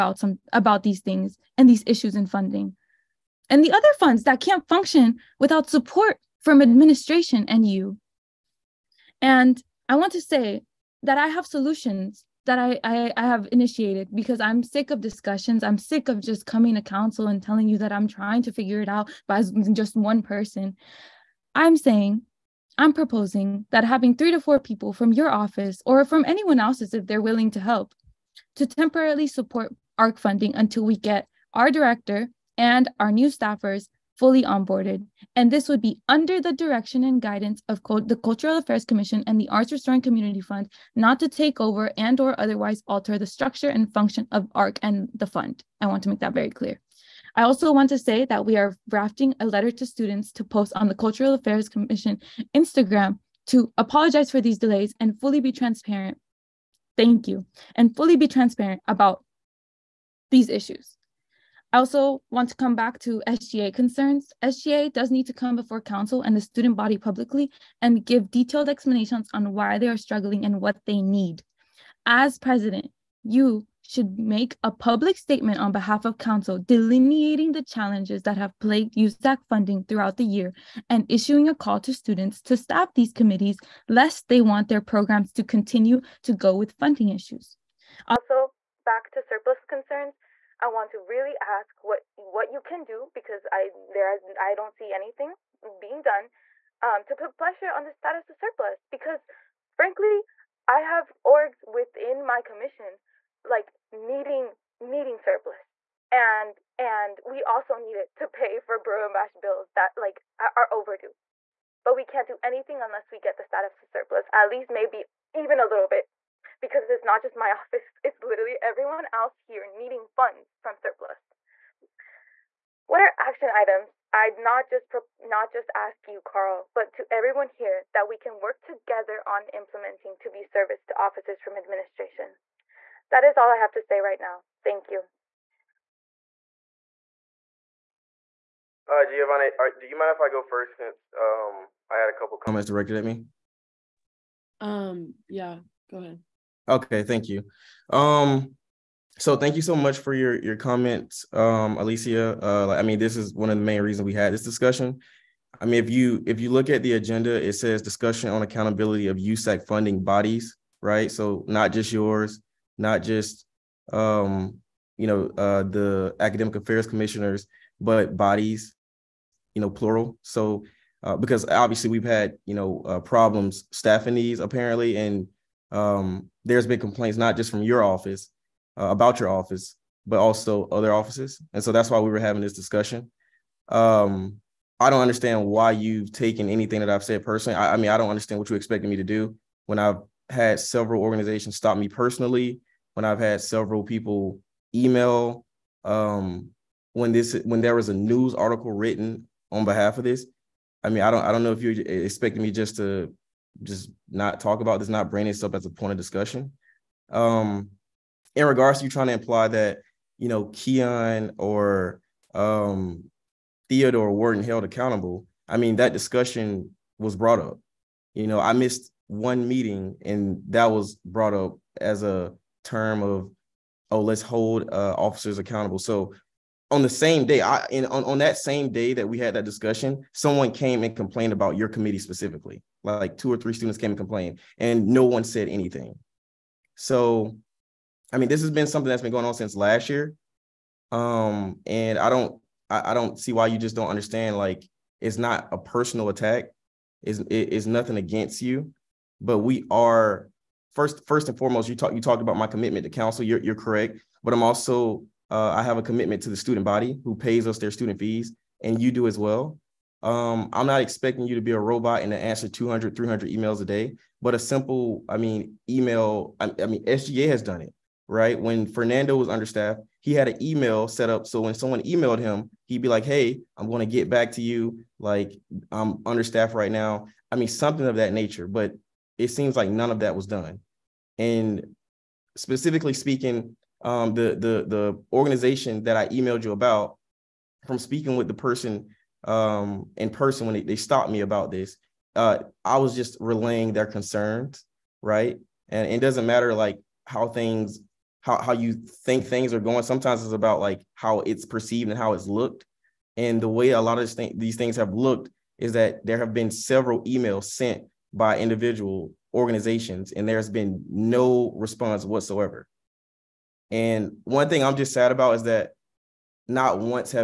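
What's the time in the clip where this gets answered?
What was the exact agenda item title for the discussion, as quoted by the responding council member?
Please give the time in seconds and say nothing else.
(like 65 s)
158 s.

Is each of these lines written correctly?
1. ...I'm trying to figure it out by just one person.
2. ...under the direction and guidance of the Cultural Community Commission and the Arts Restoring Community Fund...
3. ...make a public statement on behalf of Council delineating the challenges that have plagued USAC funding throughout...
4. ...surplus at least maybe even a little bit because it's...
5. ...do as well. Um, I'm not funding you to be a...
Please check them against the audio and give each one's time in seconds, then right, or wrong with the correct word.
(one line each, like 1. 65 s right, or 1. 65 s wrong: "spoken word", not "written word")
1. 17 s right
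2. 36 s wrong: "Affairs", not "Community"
3. 74 s right
4. 113 s right
5. 258 s wrong: "expecting", not "funding".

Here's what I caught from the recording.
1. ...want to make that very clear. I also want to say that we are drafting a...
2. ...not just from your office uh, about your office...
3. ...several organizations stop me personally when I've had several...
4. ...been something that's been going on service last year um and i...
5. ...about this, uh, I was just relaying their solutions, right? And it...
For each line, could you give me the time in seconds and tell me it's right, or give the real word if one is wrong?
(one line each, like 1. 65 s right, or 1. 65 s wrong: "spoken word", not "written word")
1. 45 s right
2. 177 s right
3. 190 s right
4. 238 s wrong: "since", not "service"
5. 291 s wrong: "concerns", not "solutions".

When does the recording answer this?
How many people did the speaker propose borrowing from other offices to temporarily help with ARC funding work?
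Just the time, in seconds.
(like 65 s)
24 s.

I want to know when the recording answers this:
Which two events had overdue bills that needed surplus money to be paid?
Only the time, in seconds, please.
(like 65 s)
108 s.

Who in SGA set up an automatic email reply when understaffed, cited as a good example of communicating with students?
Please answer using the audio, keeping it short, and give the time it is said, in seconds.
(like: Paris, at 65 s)
Fernando, at 268 s.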